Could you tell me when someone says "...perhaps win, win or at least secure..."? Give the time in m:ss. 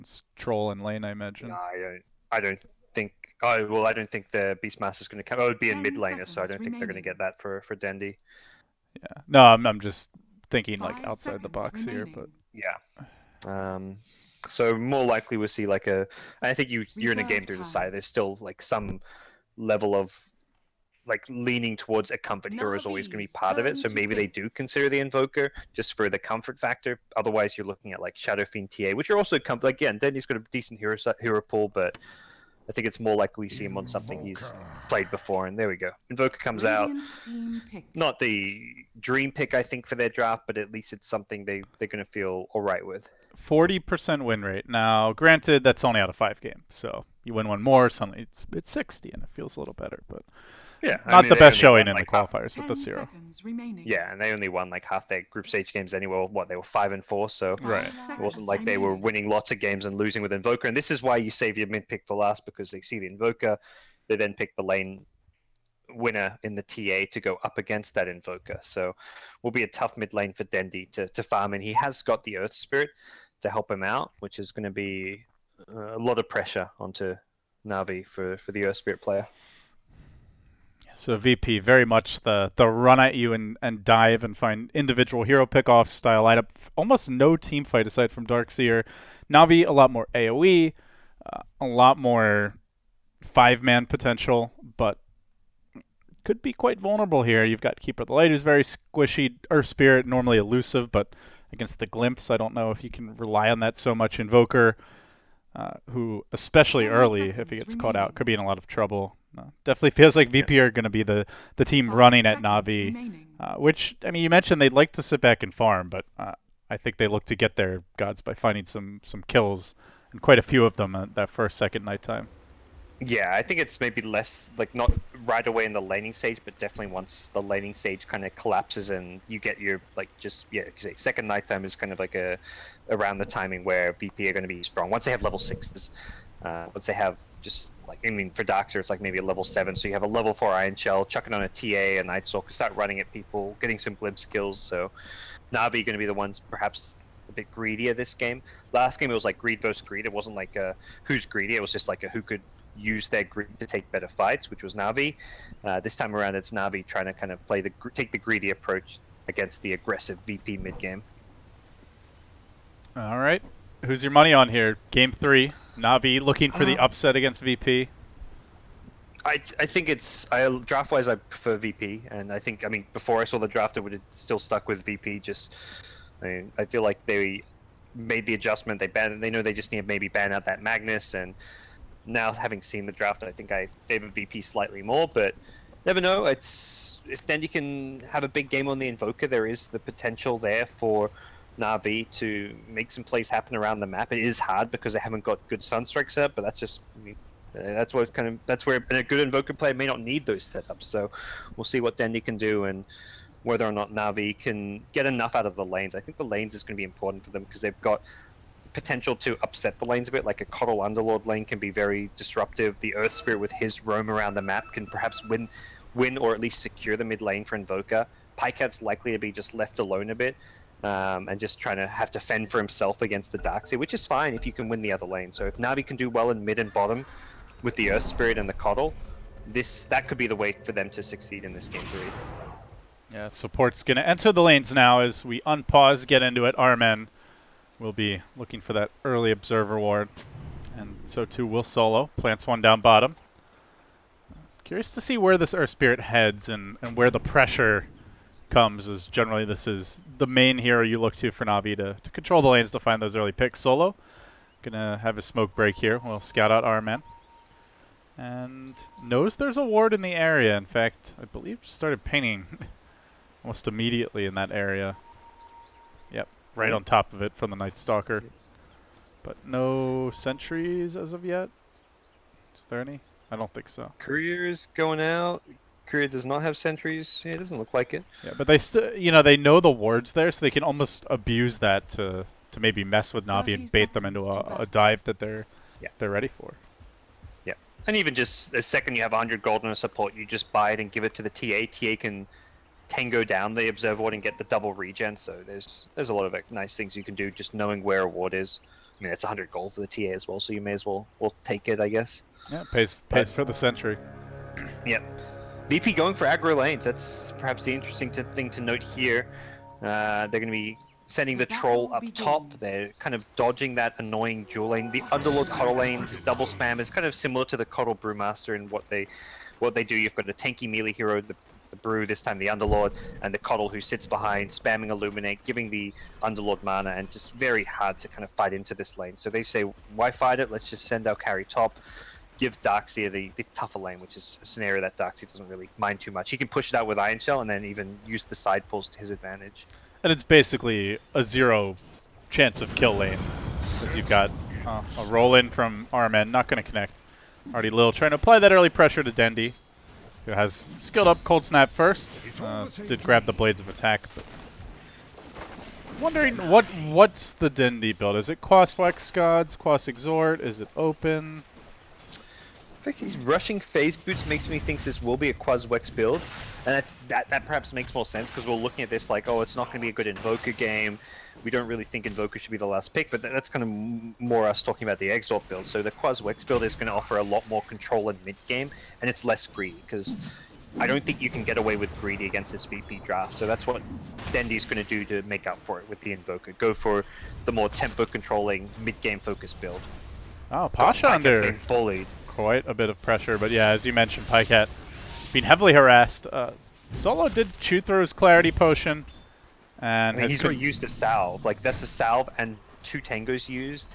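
3:34.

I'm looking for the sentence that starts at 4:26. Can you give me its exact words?
Yep, right on top of it from the Night Stalker.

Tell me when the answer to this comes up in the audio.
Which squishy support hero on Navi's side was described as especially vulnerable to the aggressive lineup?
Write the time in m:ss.
1:37.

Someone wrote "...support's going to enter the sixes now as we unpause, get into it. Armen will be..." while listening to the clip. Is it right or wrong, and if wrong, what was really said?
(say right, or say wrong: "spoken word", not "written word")
wrong: "lanes", not "sixes".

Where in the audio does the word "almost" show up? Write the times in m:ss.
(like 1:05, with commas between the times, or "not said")
1:26, 4:23, 4:40.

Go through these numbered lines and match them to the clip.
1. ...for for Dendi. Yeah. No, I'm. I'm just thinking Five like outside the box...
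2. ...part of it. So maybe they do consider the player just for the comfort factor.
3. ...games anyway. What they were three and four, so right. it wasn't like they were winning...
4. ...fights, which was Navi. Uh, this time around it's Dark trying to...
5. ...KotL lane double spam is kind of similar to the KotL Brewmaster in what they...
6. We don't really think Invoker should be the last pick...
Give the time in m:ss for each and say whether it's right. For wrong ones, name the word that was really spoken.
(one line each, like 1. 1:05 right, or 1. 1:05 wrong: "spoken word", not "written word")
1. 0:07 right
2. 0:23 wrong: "invoker", not "player"
3. 0:55 wrong: "five", not "three"
4. 2:34 wrong: "Navi", not "Dark"
5. 5:15 right
6. 6:11 right.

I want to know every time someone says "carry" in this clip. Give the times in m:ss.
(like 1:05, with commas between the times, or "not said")
5:31.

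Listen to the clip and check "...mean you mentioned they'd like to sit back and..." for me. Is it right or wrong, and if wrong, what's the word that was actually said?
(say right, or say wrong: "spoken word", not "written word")
right.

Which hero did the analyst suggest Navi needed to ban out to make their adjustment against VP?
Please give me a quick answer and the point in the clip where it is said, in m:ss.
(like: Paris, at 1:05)
Magnus, at 3:00.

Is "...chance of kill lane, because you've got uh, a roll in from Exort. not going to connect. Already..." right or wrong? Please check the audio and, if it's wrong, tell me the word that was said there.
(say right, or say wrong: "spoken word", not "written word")
wrong: "Rmn", not "Exort".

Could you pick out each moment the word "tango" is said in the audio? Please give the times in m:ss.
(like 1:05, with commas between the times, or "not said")
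4:52, 6:43.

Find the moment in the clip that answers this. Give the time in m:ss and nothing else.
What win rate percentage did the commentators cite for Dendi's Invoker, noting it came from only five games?
0:43.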